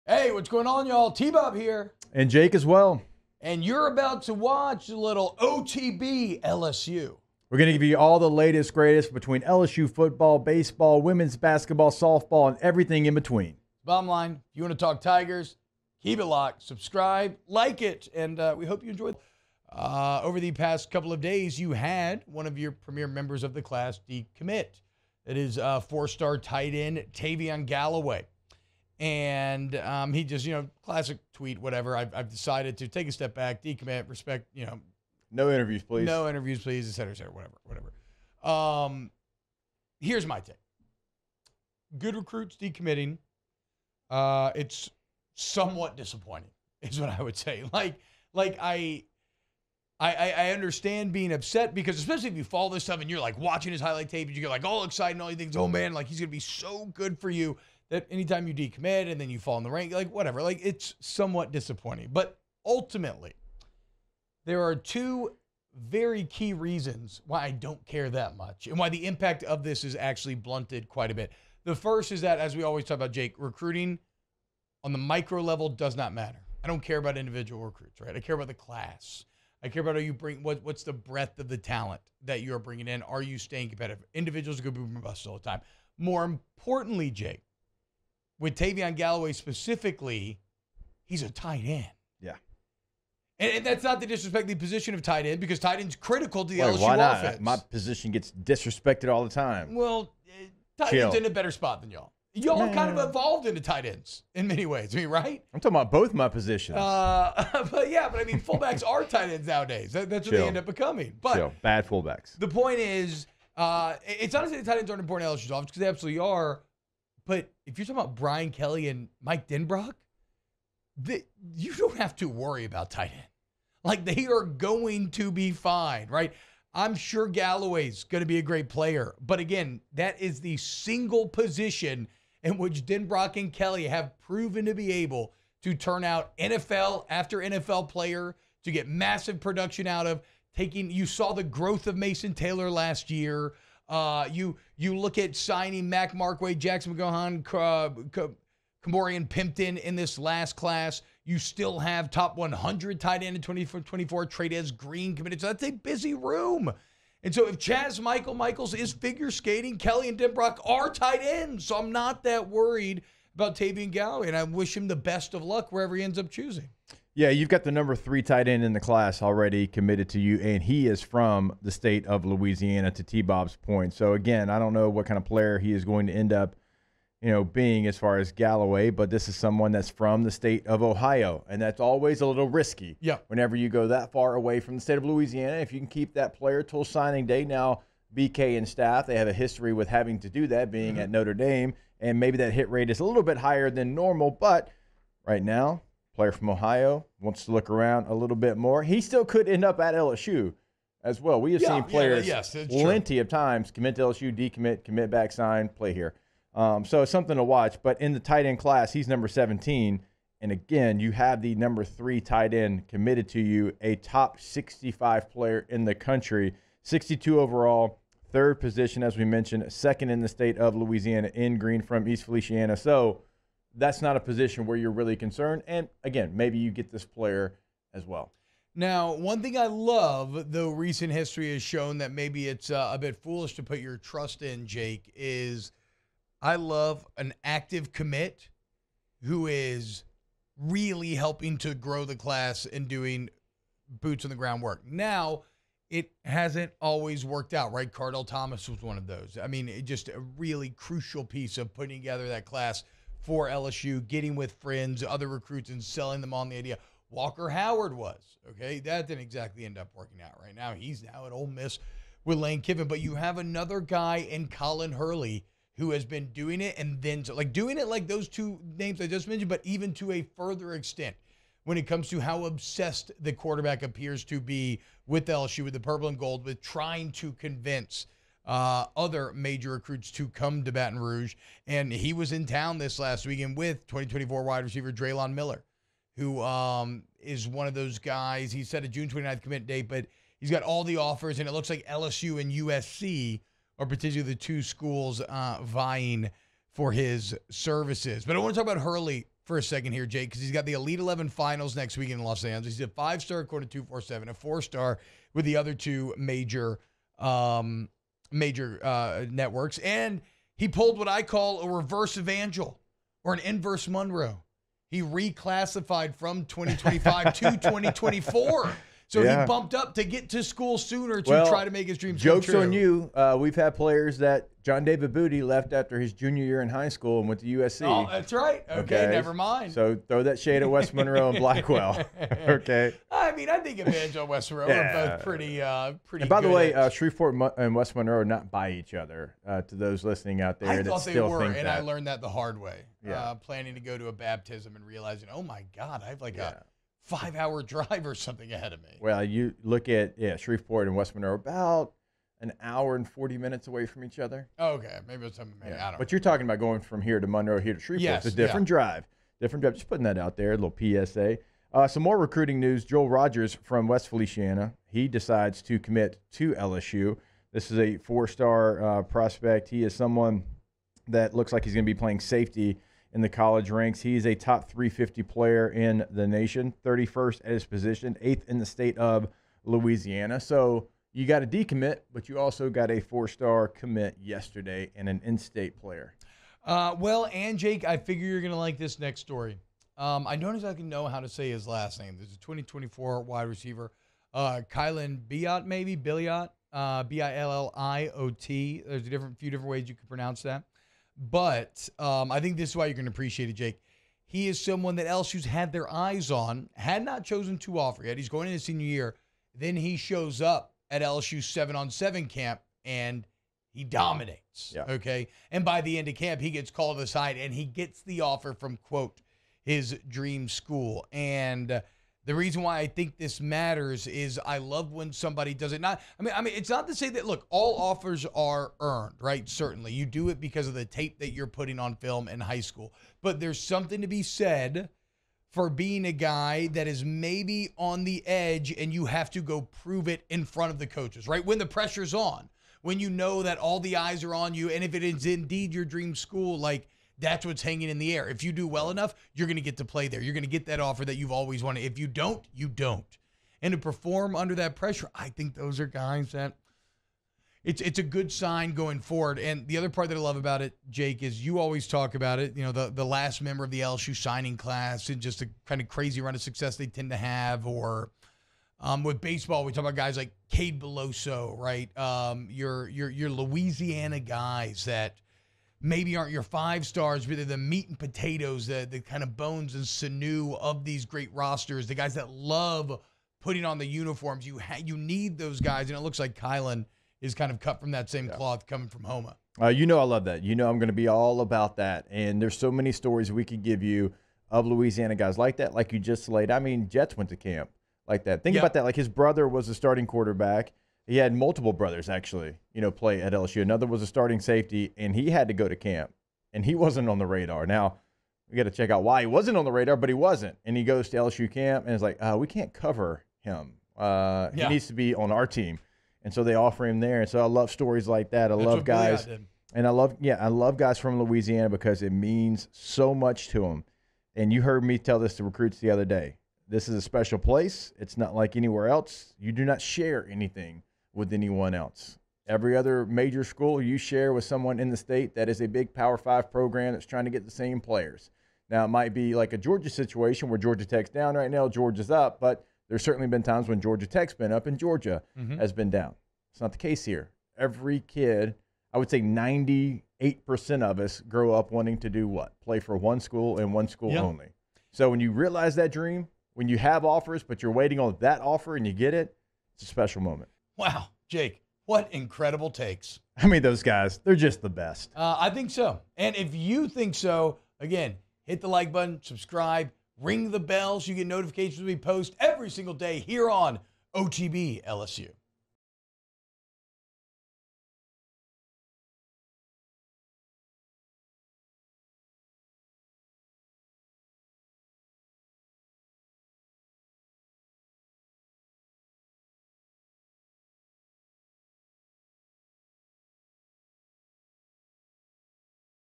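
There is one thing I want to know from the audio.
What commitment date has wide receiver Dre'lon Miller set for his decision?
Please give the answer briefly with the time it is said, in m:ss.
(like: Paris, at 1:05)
June 29, at 4:48.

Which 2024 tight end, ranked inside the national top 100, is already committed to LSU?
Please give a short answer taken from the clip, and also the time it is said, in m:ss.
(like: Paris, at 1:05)
Trey'Dez Green, at 2:34.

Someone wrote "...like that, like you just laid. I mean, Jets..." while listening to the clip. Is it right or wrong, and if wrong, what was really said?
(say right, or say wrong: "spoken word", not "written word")
right.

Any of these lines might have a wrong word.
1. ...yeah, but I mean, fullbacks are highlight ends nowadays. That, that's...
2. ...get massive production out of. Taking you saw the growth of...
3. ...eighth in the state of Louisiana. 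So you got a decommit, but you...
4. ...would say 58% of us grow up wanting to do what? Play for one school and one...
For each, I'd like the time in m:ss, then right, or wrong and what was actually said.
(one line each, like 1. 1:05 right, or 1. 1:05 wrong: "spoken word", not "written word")
1. 1:47 wrong: "tight", not "highlight"
2. 2:18 right
3. 6:18 right
4. 9:08 wrong: "98", not "58".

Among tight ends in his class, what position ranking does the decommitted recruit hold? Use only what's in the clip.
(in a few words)
17.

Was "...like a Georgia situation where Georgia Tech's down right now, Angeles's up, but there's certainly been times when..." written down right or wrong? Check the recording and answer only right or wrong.
wrong.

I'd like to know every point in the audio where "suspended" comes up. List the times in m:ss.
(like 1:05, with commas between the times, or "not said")
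not said.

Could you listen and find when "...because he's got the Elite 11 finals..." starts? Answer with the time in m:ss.
5:00.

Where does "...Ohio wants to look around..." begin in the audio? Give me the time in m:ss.
3:16.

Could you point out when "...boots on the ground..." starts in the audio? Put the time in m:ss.
4:04.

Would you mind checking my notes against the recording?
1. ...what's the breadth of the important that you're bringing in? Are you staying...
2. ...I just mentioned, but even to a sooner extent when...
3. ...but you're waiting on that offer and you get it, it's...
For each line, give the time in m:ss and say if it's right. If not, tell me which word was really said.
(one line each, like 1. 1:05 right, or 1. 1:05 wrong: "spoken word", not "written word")
1. 1:20 wrong: "talent", not "important"
2. 4:29 wrong: "further", not "sooner"
3. 9:17 right.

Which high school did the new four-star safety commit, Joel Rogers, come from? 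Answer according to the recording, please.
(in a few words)
West Feliciana.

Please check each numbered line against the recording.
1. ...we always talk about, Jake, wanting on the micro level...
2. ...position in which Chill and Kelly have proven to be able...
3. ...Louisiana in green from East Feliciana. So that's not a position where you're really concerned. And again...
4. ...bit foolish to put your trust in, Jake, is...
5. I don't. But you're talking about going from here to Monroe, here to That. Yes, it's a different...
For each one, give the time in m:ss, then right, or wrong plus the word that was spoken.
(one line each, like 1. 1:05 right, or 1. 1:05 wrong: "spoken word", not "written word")
1. 1:12 wrong: "recruiting", not "wanting"
2. 2:11 wrong: "Denbrock", not "Chill"
3. 3:40 right
4. 3:52 right
5. 5:55 wrong: "Shreveport", not "That".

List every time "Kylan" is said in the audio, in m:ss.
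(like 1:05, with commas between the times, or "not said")
6:34, 8:06.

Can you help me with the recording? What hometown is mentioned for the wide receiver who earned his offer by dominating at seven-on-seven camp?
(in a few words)
Houma.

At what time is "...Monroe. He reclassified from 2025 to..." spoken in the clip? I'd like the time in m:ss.
5:13.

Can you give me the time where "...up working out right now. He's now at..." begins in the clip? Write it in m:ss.
4:19.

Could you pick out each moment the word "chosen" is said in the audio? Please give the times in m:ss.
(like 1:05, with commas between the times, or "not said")
6:47.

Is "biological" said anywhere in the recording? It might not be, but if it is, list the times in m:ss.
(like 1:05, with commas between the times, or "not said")
not said.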